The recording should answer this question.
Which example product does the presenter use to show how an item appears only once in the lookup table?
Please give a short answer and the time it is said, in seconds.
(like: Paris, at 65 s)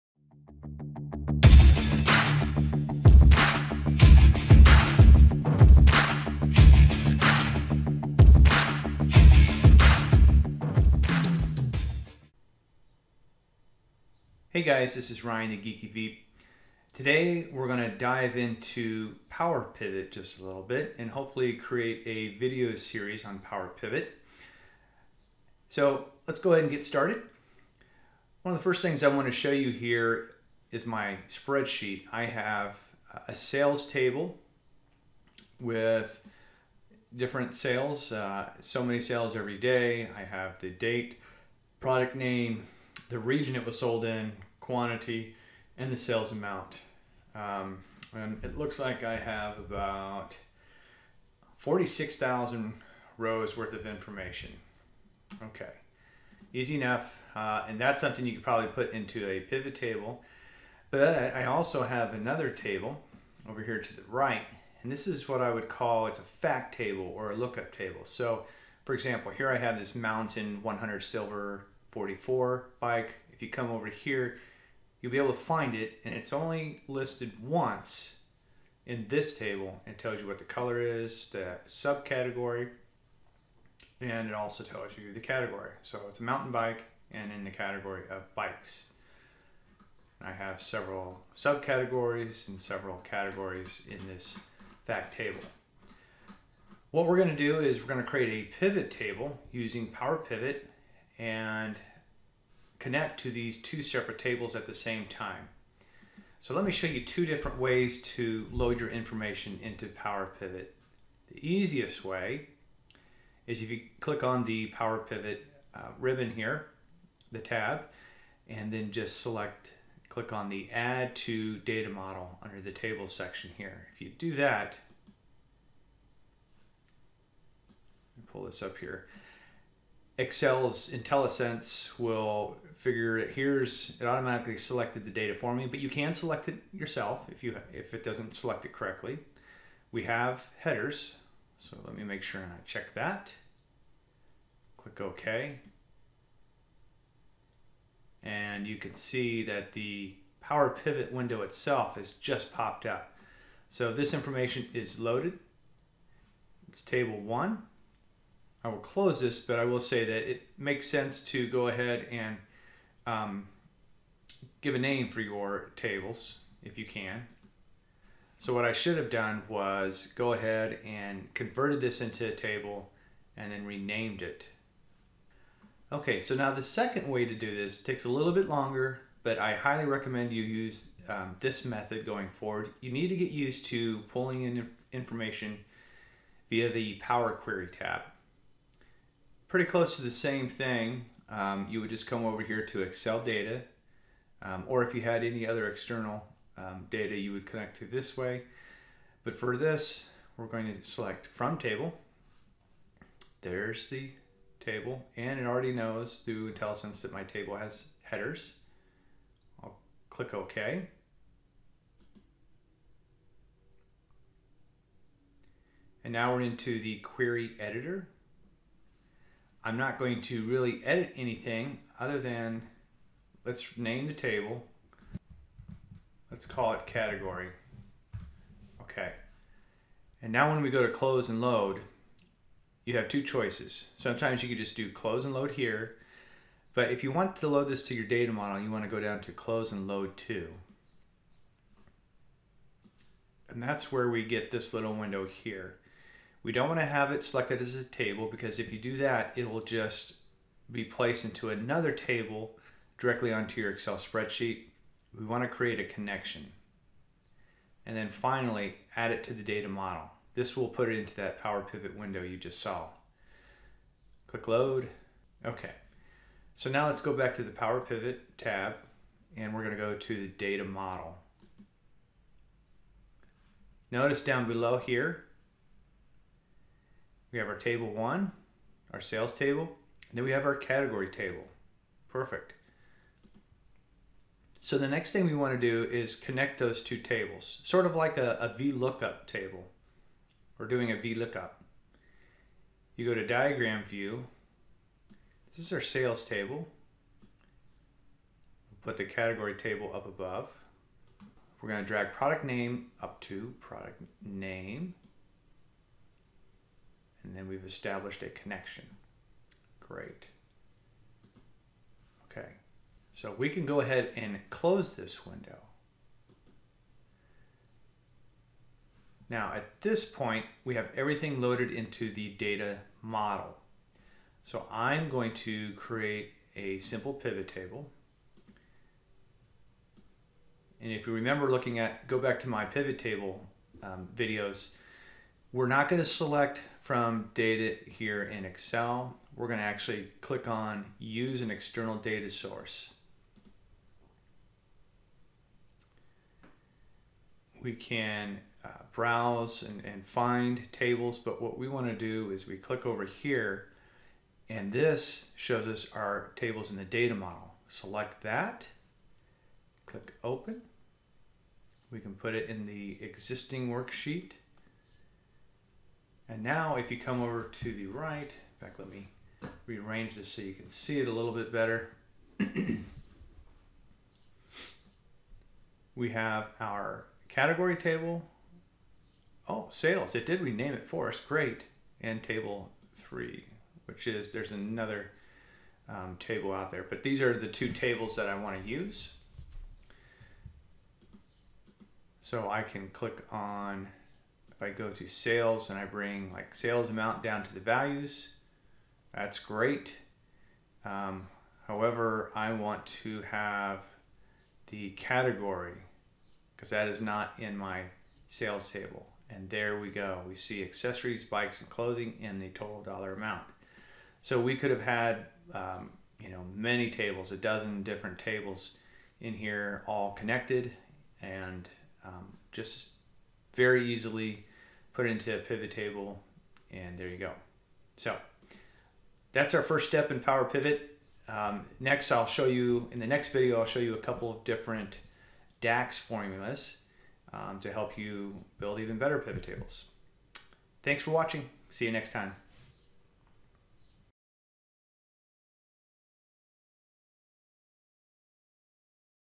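mountain 100 silver 44, at 69 s.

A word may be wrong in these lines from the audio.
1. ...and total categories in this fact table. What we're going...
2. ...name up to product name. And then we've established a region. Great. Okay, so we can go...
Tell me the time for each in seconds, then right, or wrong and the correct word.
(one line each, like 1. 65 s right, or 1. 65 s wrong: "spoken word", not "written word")
1. 92 s wrong: "several", not "total"
2. 302 s wrong: "connection", not "region".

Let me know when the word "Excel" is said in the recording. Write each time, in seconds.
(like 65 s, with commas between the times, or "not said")
130 s, 192 s, 253 s, 338 s.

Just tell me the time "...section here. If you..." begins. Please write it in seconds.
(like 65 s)
123 s.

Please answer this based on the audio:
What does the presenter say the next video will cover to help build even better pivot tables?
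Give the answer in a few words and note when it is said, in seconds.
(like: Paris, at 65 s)
DAX formulas, at 435 s.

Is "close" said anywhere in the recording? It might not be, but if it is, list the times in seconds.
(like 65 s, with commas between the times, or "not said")
158 s, 189 s, 230 s, 234 s, 239 s, 314 s.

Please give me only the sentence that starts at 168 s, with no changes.
So what I should have done was go ahead and converted this into a table and then renamed it.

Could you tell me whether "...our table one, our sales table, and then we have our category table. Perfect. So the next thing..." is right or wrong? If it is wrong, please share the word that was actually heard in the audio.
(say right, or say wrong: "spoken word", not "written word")
right.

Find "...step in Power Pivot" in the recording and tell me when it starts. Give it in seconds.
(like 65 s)
429 s.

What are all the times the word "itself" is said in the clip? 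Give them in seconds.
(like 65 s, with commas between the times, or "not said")
151 s.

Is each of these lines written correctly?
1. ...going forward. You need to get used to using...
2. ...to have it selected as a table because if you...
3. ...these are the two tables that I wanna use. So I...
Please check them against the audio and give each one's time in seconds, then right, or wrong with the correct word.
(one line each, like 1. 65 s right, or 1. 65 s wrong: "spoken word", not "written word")
1. 182 s wrong: "pulling", not "using"
2. 246 s right
3. 387 s right.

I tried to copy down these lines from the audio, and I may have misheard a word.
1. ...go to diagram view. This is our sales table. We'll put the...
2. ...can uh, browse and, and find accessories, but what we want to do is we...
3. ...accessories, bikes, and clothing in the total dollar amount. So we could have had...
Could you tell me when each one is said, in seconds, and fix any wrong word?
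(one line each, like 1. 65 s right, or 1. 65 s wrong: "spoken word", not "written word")
1. 293 s right
2. 347 s wrong: "tables", not "accessories"
3. 410 s right.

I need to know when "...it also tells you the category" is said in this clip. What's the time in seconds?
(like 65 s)
84 s.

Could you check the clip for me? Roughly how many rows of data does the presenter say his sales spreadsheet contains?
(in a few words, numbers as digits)
46,000.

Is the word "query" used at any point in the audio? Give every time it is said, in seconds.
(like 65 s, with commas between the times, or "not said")
187 s, 216 s.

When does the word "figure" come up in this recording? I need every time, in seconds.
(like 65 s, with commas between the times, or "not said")
132 s.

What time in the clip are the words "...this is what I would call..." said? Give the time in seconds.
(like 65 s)
64 s.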